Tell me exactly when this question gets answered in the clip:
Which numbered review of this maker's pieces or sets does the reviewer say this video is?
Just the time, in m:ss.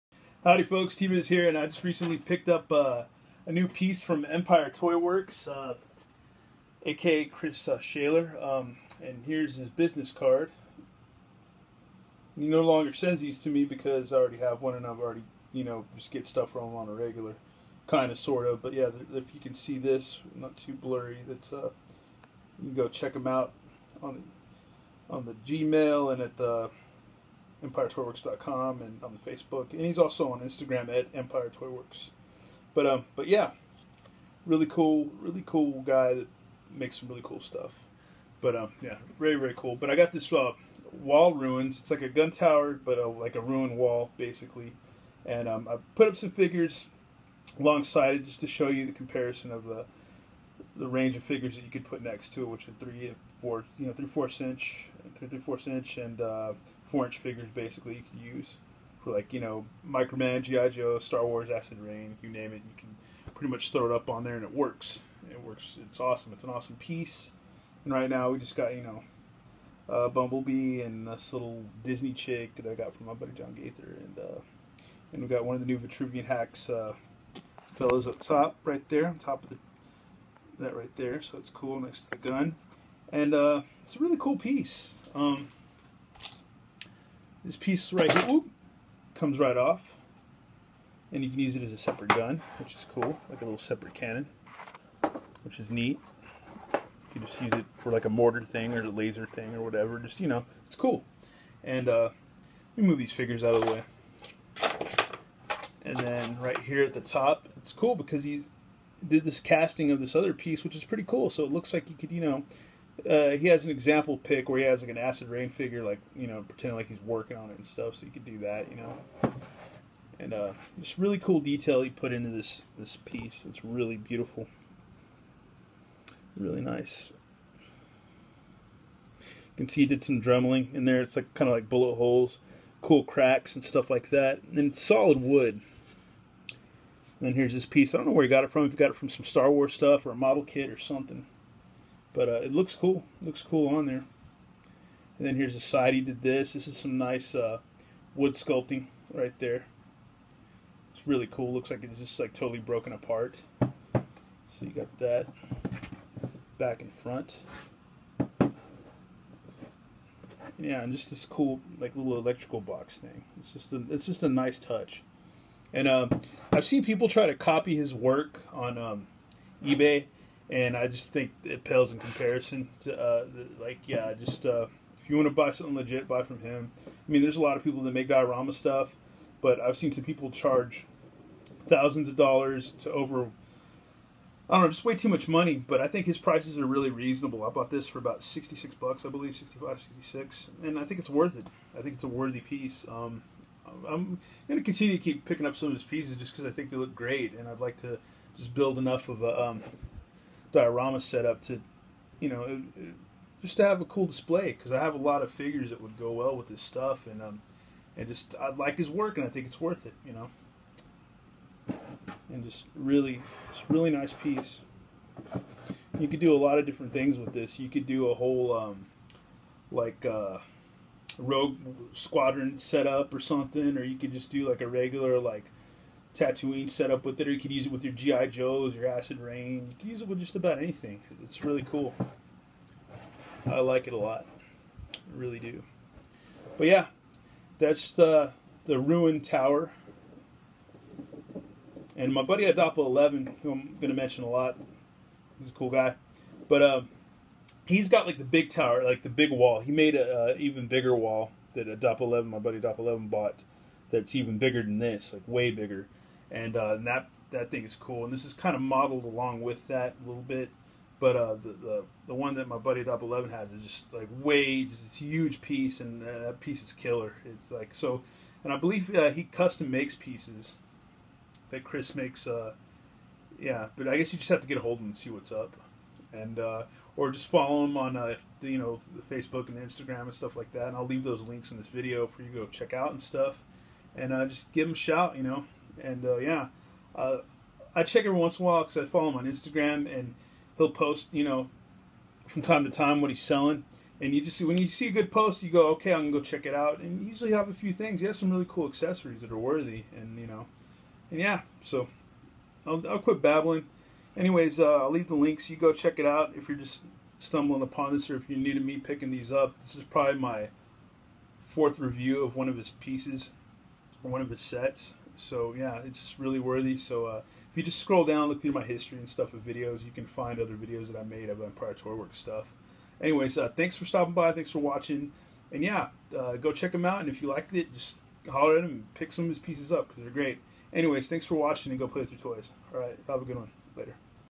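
5:11.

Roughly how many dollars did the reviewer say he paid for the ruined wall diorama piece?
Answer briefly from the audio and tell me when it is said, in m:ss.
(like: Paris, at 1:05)
66, at 3:08.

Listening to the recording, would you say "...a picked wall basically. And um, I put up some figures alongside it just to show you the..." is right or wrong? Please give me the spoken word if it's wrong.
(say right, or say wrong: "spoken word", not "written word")
wrong: "ruined", not "picked".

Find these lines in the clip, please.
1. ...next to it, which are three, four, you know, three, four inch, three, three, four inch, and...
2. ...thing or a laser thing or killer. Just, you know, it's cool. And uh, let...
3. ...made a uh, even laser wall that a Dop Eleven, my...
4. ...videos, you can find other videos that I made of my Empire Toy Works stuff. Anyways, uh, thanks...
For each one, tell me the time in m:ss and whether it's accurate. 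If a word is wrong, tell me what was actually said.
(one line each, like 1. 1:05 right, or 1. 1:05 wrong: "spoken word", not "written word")
1. 0:52 right
2. 1:38 wrong: "whatever", not "killer"
3. 4:09 wrong: "bigger", not "laser"
4. 5:19 right.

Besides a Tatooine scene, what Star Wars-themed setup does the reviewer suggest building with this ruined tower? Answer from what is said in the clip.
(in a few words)
Rogue Squadron.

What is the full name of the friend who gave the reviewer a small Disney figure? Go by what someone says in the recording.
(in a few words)
John Gaither.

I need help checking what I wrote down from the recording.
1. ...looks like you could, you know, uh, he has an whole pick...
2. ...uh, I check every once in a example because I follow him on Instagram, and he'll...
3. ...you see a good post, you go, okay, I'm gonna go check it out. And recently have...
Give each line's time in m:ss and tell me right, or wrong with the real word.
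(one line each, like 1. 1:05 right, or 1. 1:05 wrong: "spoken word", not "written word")
1. 1:51 wrong: "example", not "whole"
2. 4:46 wrong: "while", not "example"
3. 4:54 wrong: "usually", not "recently".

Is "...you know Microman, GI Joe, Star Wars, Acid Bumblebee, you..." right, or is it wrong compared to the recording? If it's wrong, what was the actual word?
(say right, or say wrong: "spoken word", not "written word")
wrong: "Rain", not "Bumblebee".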